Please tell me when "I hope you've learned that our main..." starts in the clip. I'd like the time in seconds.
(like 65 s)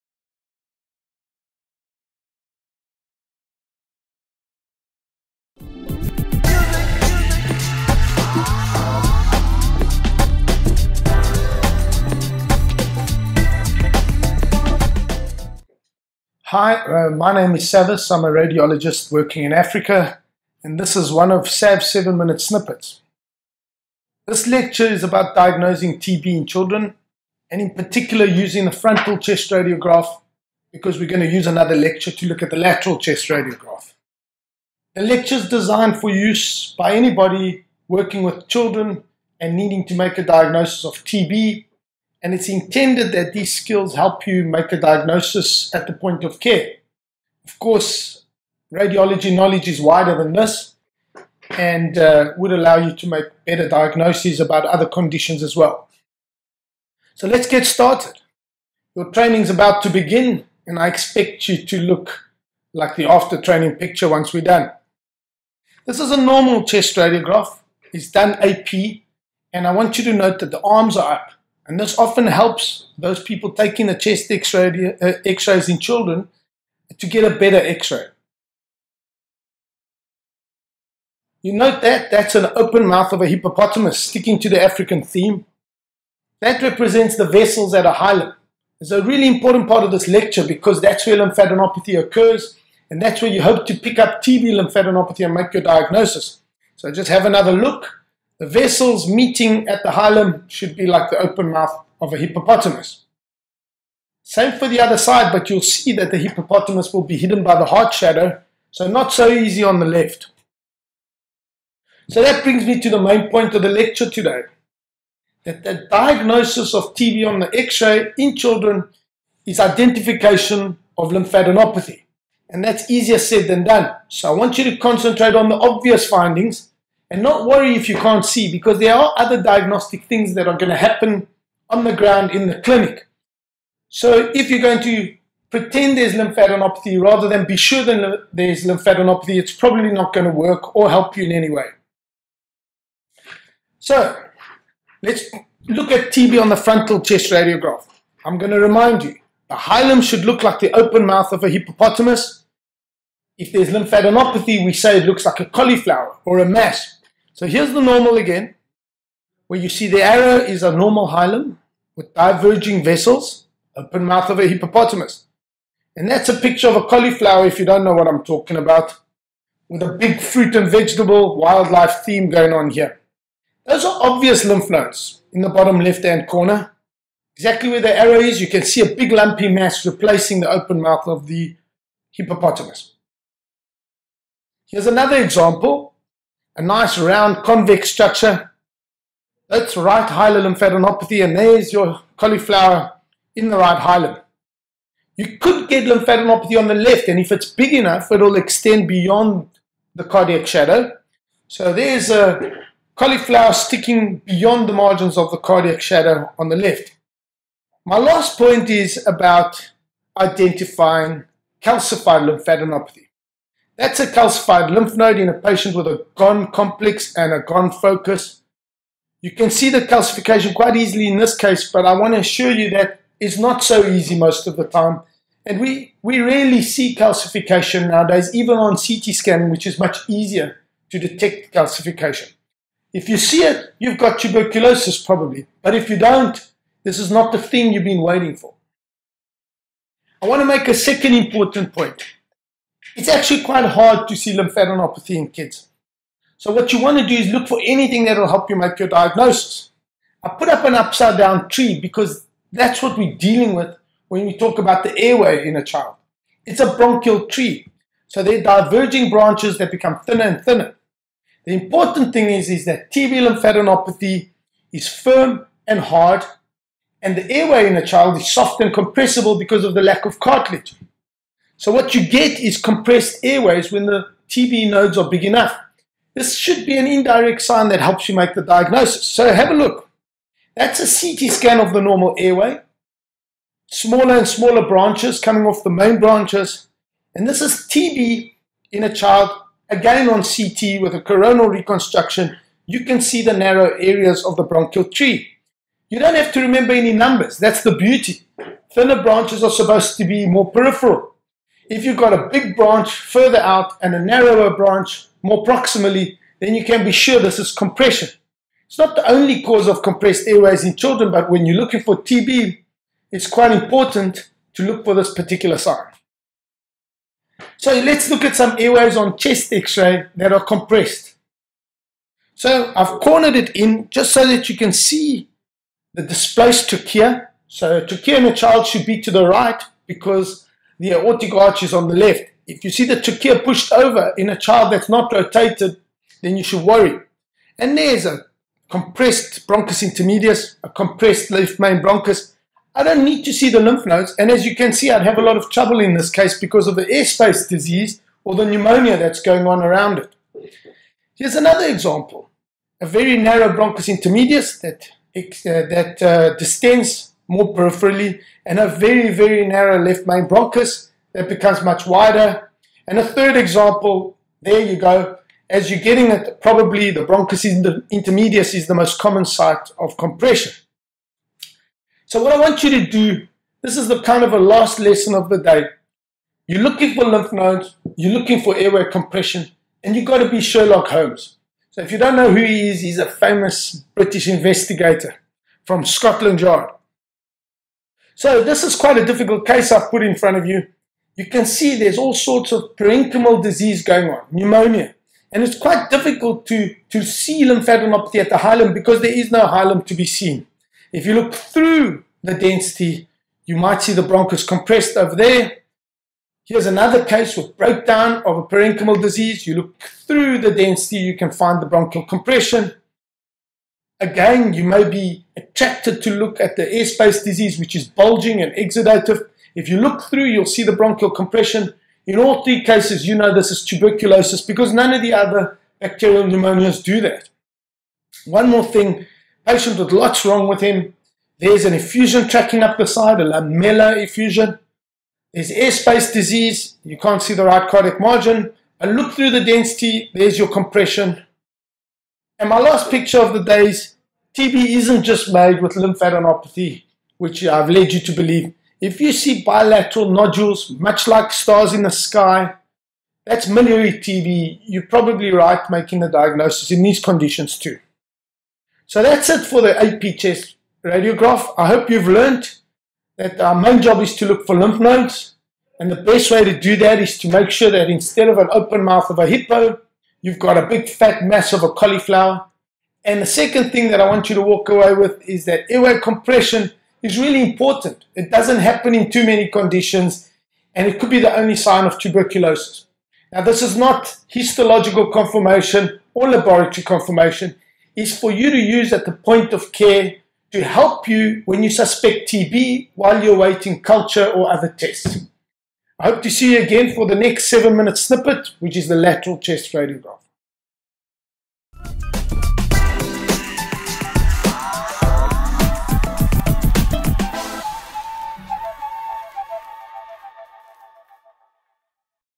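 461 s.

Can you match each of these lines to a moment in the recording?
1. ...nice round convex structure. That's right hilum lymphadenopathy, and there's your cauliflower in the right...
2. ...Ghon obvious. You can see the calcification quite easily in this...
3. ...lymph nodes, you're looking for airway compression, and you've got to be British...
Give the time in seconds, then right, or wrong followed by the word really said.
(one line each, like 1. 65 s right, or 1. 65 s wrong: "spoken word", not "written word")
1. 186 s right
2. 217 s wrong: "focus", not "obvious"
3. 377 s wrong: "Sherlock", not "British".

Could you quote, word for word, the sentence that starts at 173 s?
Those are obvious lymph nodes in the bottom left-hand corner.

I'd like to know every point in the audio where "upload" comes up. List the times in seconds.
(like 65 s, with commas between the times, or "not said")
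not said.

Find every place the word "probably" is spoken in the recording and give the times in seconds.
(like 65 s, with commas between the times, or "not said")
139 s, 235 s, 366 s, 454 s.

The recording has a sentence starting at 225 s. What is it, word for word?
And we, we rarely see calcification nowadays, even on CT scanning, which is much easier to detect calcification.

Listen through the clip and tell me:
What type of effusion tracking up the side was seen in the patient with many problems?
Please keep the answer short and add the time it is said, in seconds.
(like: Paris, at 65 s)
Lamellar effusion, at 433 s.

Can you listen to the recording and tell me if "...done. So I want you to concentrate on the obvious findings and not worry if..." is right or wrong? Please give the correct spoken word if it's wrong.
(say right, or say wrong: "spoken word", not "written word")
right.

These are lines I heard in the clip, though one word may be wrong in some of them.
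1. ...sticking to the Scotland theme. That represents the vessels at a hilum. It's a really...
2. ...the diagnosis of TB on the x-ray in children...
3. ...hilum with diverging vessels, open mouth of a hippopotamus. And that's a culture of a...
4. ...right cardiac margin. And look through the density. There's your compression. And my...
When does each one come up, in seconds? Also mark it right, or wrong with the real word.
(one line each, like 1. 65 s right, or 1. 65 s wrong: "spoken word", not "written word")
1. 84 s wrong: "African", not "Scotland"
2. 115 s right
3. 161 s wrong: "picture", not "culture"
4. 437 s right.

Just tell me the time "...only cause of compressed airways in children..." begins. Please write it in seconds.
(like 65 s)
309 s.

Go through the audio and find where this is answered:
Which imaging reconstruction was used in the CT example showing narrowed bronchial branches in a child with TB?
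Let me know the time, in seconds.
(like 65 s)
291 s.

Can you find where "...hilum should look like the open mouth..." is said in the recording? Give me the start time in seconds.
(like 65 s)
149 s.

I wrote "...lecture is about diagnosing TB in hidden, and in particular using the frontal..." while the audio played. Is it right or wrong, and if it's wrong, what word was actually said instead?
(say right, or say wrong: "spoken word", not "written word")
wrong: "children", not "hidden".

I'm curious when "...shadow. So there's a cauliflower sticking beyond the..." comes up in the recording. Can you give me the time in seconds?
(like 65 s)
200 s.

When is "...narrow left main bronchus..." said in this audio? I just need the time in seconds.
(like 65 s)
359 s.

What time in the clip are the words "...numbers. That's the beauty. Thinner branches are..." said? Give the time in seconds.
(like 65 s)
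296 s.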